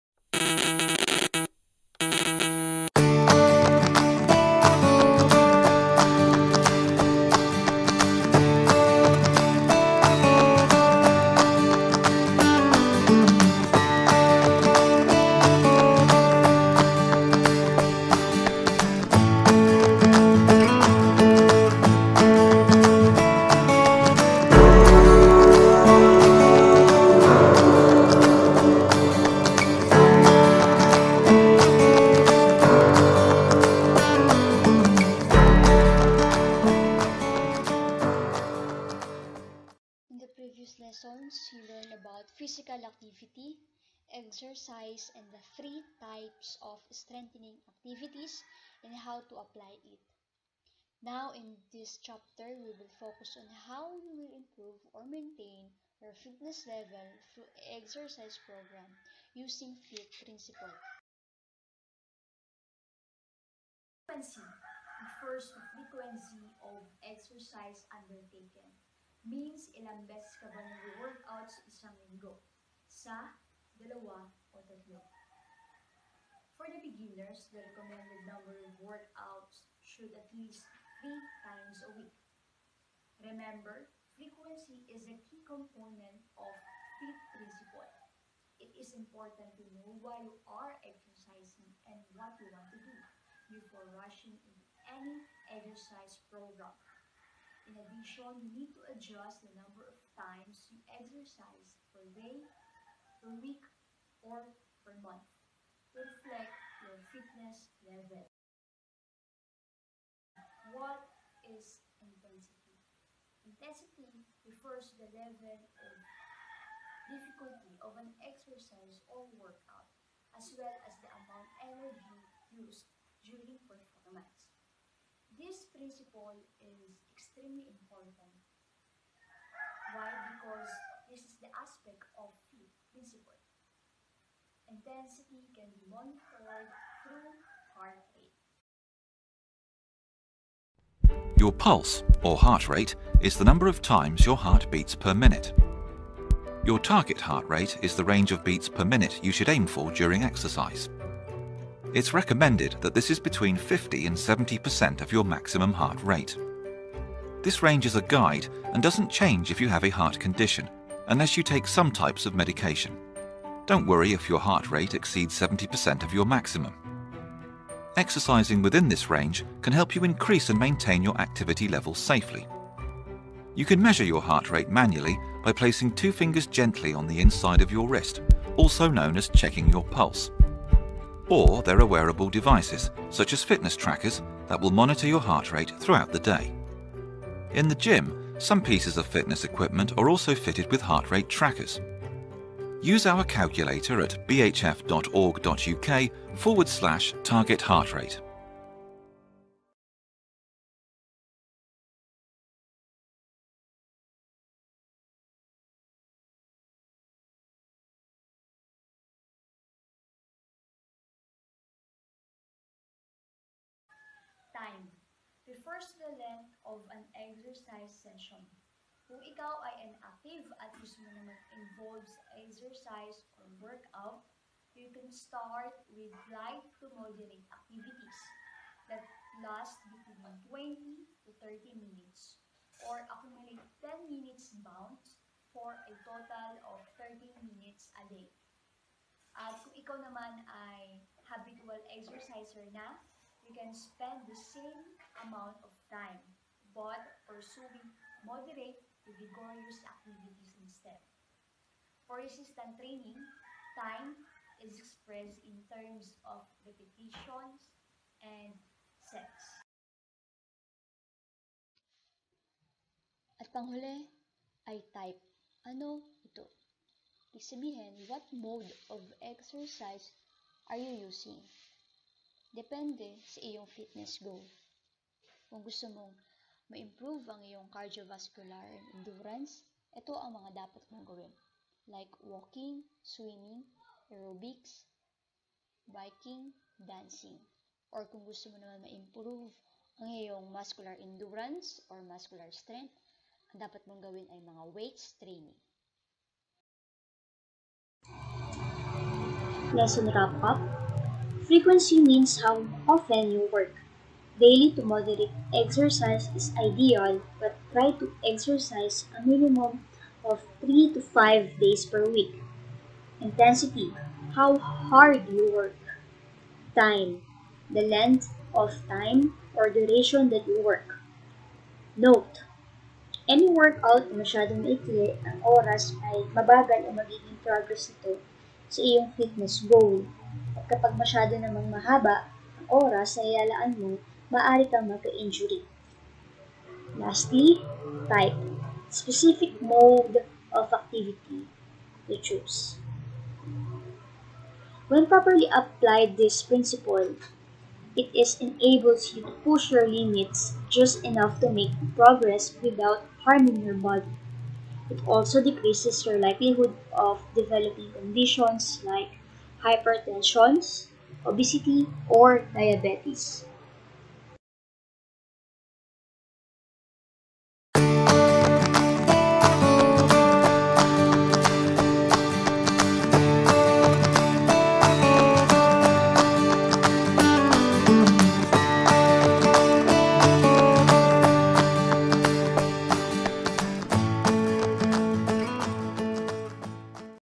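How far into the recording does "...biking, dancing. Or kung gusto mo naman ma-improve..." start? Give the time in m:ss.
4:45.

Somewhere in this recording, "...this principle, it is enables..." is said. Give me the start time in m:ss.
5:46.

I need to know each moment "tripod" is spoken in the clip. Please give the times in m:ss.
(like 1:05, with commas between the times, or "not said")
not said.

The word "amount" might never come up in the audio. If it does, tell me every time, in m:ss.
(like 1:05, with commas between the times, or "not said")
2:01, 4:05.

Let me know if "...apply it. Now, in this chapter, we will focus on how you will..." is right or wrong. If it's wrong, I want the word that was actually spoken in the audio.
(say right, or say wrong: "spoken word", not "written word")
right.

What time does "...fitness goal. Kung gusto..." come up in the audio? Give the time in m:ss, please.
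4:33.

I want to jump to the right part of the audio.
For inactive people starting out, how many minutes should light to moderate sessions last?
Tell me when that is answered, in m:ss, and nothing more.
3:50.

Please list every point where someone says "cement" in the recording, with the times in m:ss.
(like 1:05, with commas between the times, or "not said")
not said.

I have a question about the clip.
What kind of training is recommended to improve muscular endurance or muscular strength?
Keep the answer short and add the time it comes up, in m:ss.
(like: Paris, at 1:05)
weights training, at 4:54.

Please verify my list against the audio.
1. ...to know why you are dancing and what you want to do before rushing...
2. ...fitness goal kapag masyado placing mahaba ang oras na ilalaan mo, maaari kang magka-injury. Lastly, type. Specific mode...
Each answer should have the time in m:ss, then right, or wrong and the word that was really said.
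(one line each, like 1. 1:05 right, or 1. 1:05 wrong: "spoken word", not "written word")
1. 1:29 wrong: "exercising", not "dancing"
2. 5:29 wrong: "namang", not "placing".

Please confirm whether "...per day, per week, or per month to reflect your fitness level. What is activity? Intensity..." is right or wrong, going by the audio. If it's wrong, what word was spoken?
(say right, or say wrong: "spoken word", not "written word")
wrong: "intensity", not "activity".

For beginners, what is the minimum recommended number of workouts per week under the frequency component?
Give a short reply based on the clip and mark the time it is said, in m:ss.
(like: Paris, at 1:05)
3 times a week, at 1:21.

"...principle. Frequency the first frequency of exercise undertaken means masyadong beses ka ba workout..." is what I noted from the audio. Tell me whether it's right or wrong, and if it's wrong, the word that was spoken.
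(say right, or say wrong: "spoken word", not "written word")
wrong: "ilang", not "masyadong".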